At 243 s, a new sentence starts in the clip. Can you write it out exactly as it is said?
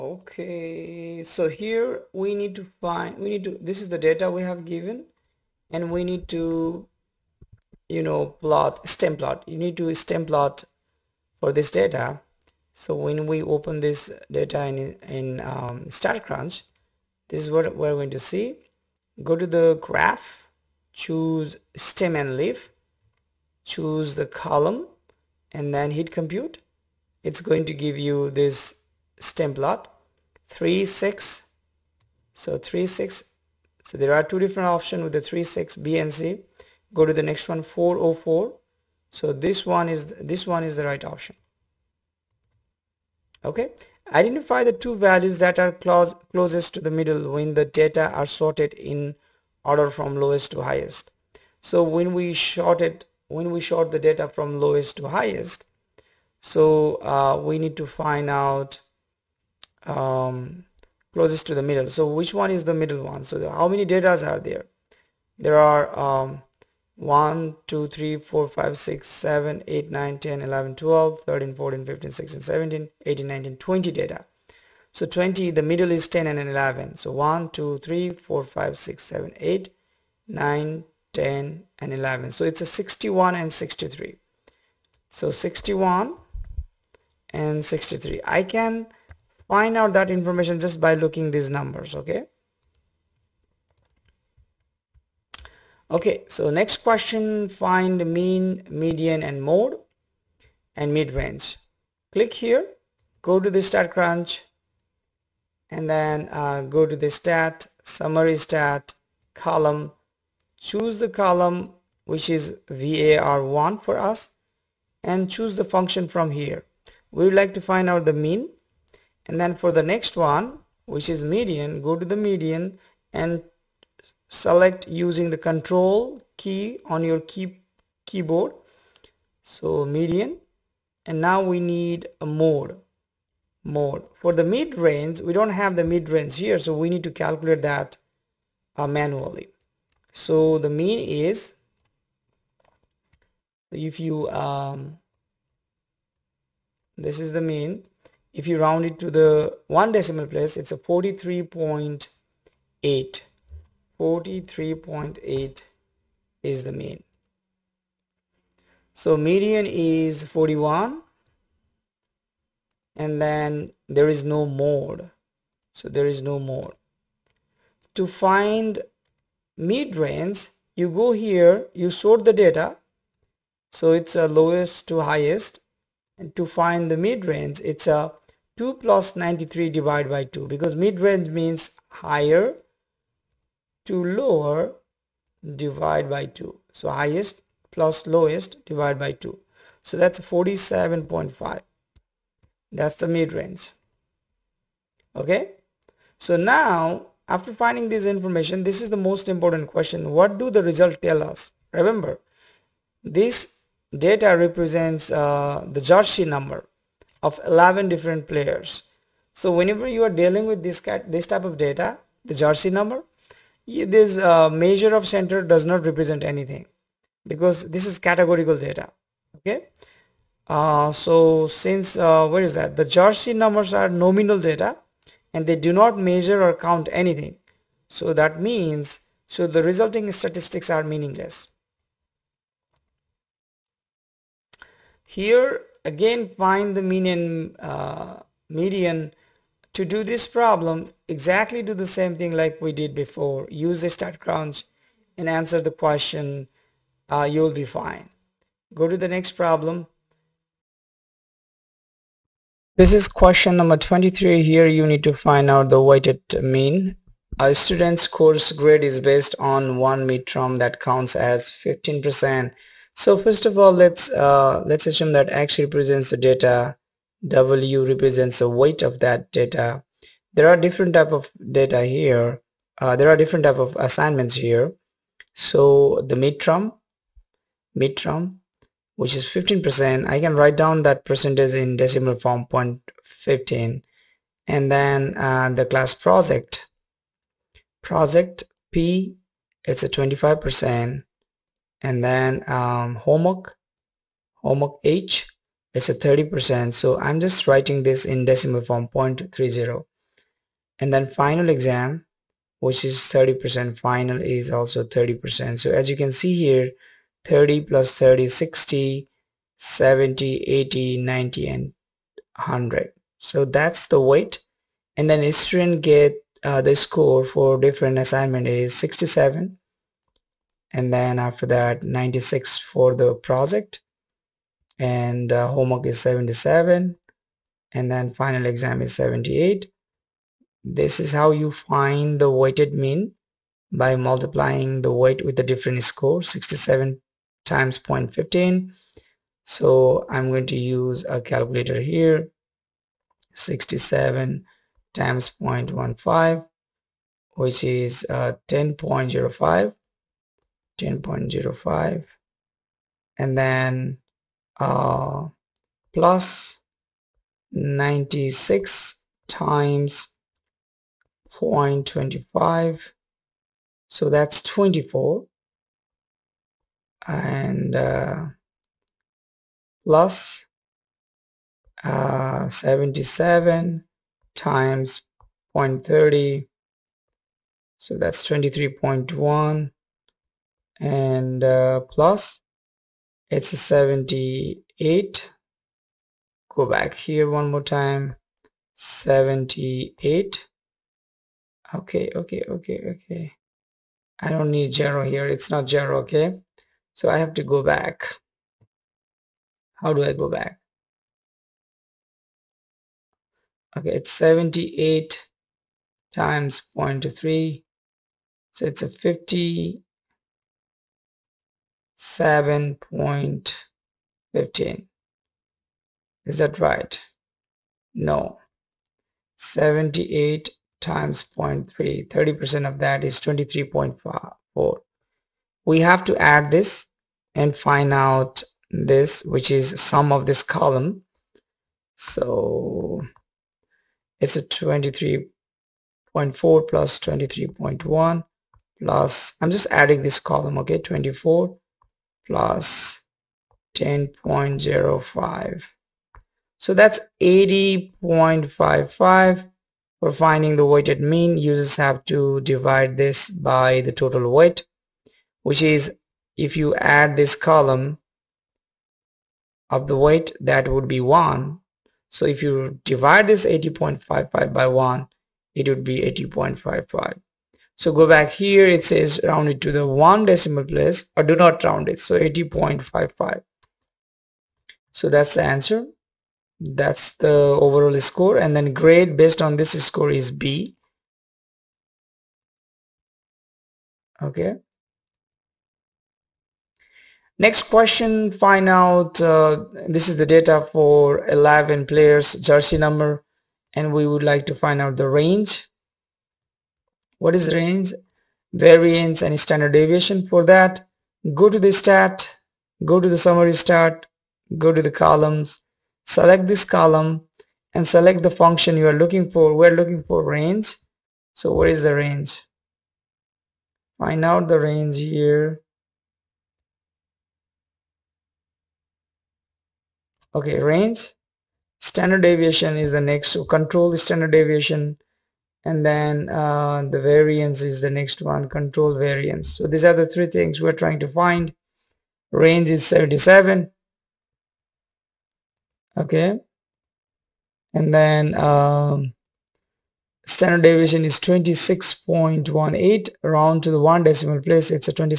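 Use a crunch and answer the question.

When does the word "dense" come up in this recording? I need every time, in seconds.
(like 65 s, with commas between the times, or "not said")
not said.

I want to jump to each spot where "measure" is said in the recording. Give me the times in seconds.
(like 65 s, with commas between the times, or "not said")
214 s, 225 s.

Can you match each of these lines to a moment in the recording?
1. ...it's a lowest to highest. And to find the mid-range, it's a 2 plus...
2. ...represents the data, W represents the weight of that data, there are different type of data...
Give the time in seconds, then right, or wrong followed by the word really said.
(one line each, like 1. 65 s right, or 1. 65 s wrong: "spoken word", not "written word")
1. 173 s right
2. 265 s right.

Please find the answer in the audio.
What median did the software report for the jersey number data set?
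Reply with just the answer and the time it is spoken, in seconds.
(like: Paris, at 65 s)
41, at 159 s.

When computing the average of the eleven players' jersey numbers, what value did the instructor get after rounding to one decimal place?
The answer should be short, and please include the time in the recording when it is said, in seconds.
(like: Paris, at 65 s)
43.8, at 150 s.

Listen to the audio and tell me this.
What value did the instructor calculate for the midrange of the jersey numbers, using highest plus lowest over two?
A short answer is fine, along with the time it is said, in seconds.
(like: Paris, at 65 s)
47.5, at 190 s.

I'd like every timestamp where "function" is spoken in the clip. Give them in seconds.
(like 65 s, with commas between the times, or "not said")
115 s, 508 s.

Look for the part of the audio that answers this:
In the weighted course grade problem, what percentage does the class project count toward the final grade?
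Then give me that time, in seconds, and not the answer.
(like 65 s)
289 s.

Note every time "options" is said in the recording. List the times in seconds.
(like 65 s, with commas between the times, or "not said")
34 s, 41 s.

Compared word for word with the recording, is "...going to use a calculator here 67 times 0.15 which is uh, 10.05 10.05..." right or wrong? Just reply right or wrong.
right.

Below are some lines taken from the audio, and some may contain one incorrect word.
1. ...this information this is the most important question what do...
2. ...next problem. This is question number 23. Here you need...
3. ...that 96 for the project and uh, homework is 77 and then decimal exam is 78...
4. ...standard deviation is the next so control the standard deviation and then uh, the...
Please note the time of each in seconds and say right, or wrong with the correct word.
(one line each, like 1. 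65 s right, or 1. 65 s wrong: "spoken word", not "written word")
1. 197 s right
2. 249 s right
3. 321 s wrong: "final", not "decimal"
4. 521 s right.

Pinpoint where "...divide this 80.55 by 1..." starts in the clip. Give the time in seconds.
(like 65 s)
462 s.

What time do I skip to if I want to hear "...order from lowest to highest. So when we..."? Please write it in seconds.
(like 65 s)
49 s.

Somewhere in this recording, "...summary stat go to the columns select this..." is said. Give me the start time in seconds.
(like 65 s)
503 s.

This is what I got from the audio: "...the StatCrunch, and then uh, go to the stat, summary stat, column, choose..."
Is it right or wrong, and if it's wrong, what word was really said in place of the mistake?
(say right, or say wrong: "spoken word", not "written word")
right.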